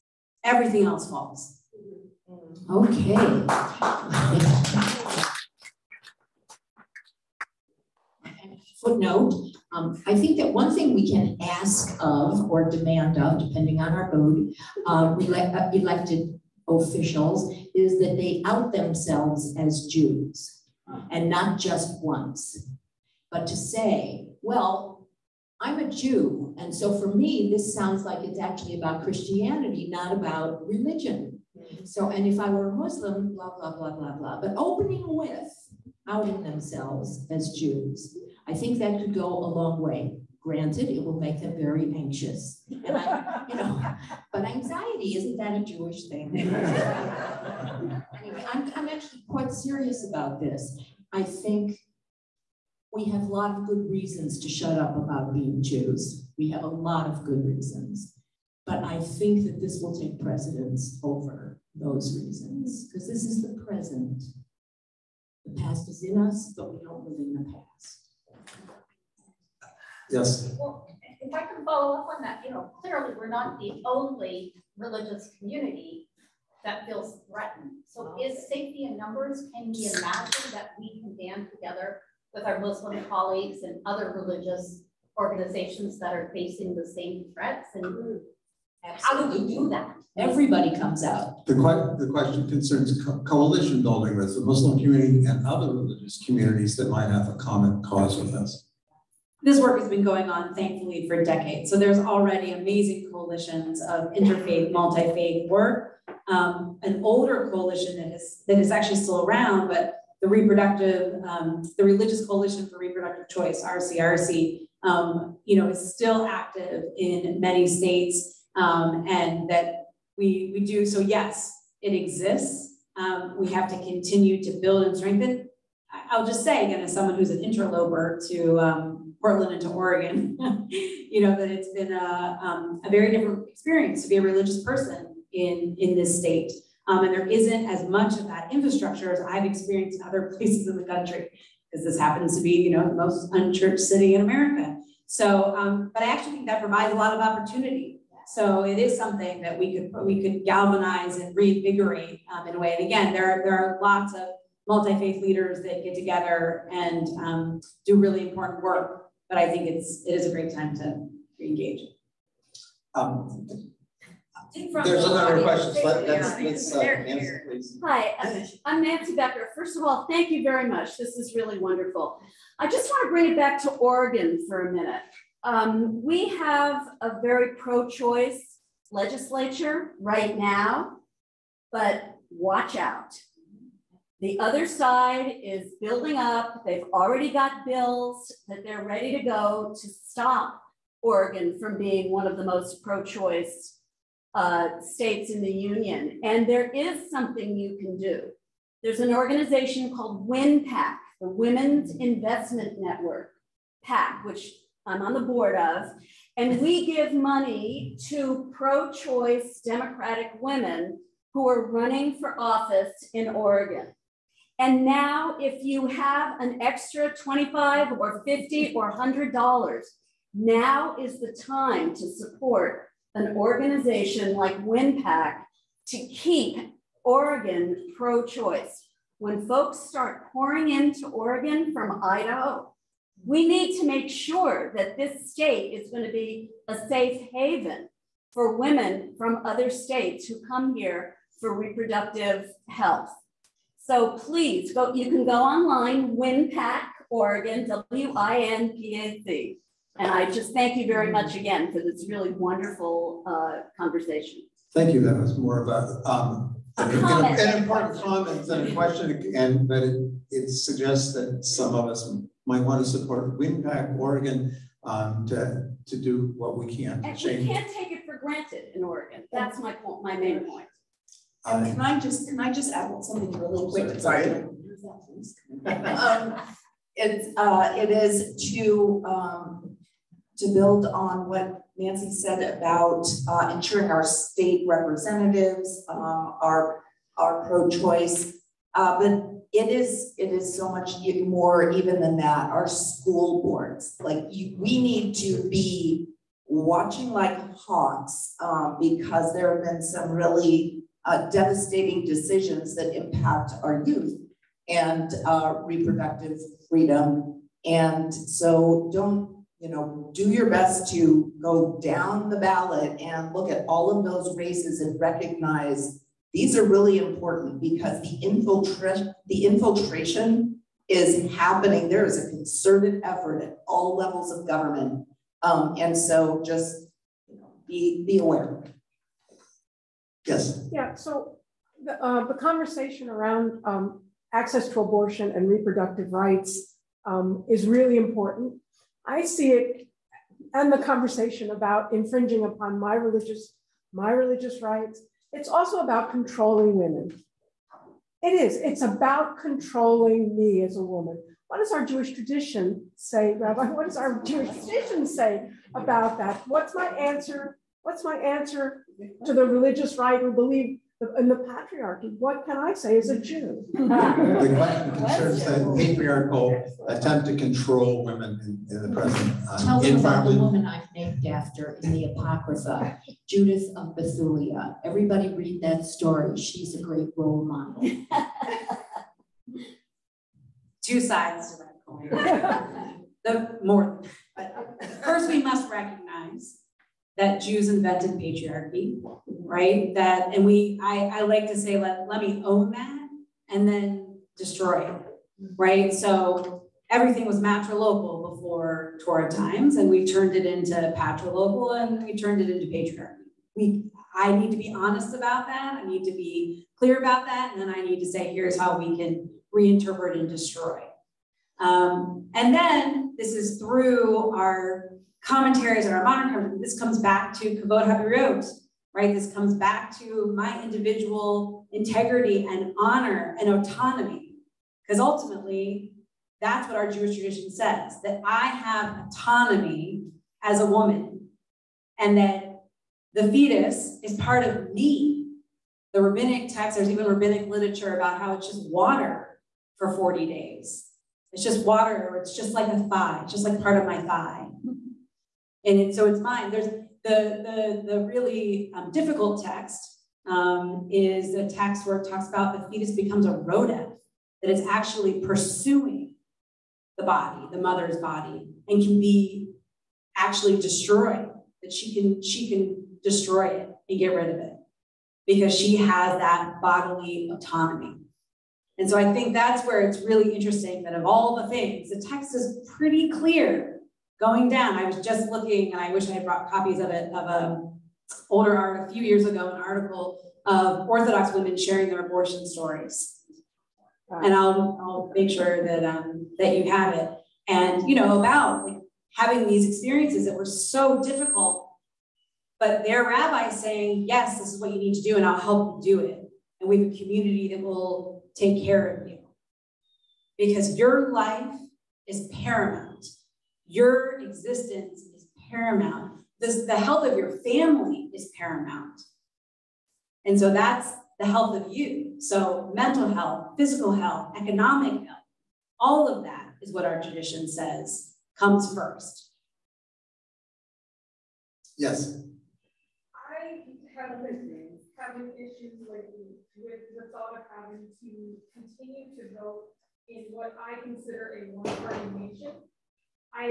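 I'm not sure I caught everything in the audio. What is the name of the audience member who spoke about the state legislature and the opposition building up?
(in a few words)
Nancy Becker.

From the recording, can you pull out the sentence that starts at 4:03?
So please go, you can go online, WinPAC Oregon, W-I-N-P-A-C.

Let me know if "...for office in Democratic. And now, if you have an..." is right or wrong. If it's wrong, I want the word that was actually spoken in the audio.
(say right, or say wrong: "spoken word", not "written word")
wrong: "Oregon", not "Democratic".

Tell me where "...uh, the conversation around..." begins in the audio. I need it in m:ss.
5:32.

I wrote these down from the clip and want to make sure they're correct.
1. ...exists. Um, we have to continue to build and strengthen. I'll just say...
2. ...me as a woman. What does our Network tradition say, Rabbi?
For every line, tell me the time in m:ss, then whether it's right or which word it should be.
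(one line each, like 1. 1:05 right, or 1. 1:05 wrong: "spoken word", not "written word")
1. 2:01 right
2. 5:50 wrong: "Jewish", not "Network".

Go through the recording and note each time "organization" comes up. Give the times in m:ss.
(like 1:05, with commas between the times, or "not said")
1:25, 3:19, 3:43.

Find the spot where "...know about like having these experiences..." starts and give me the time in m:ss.
8:07.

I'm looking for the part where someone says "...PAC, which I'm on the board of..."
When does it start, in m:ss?
3:23.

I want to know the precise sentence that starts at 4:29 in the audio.
That's my point, my main point.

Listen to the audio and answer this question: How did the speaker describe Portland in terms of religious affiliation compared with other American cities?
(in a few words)
most unchurched city.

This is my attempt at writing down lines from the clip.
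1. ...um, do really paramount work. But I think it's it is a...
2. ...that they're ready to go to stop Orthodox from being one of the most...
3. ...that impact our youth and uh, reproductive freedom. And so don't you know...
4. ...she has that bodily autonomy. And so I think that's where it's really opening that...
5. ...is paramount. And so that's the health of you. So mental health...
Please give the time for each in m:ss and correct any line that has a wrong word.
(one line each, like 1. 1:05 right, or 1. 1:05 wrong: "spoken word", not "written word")
1. 2:37 wrong: "important", not "paramount"
2. 3:08 wrong: "Oregon", not "Orthodox"
3. 5:02 right
4. 7:45 wrong: "interesting", not "opening"
5. 8:28 right.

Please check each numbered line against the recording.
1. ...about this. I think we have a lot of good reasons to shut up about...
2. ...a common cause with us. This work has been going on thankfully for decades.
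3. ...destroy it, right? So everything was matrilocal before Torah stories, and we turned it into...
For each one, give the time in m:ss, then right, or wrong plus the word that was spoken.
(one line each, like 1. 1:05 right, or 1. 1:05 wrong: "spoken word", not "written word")
1. 0:50 right
2. 1:37 right
3. 6:34 wrong: "times", not "stories".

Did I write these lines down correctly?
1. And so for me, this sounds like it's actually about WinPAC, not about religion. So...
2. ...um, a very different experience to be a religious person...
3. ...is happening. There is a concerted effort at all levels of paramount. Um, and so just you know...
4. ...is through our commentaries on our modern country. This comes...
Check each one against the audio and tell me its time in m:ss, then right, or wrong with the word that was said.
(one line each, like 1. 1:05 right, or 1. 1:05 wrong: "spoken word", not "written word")
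1. 0:26 wrong: "Christianity", not "WinPAC"
2. 2:12 right
3. 5:20 wrong: "government", not "paramount"
4. 6:53 right.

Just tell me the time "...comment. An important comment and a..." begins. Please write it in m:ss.
4:17.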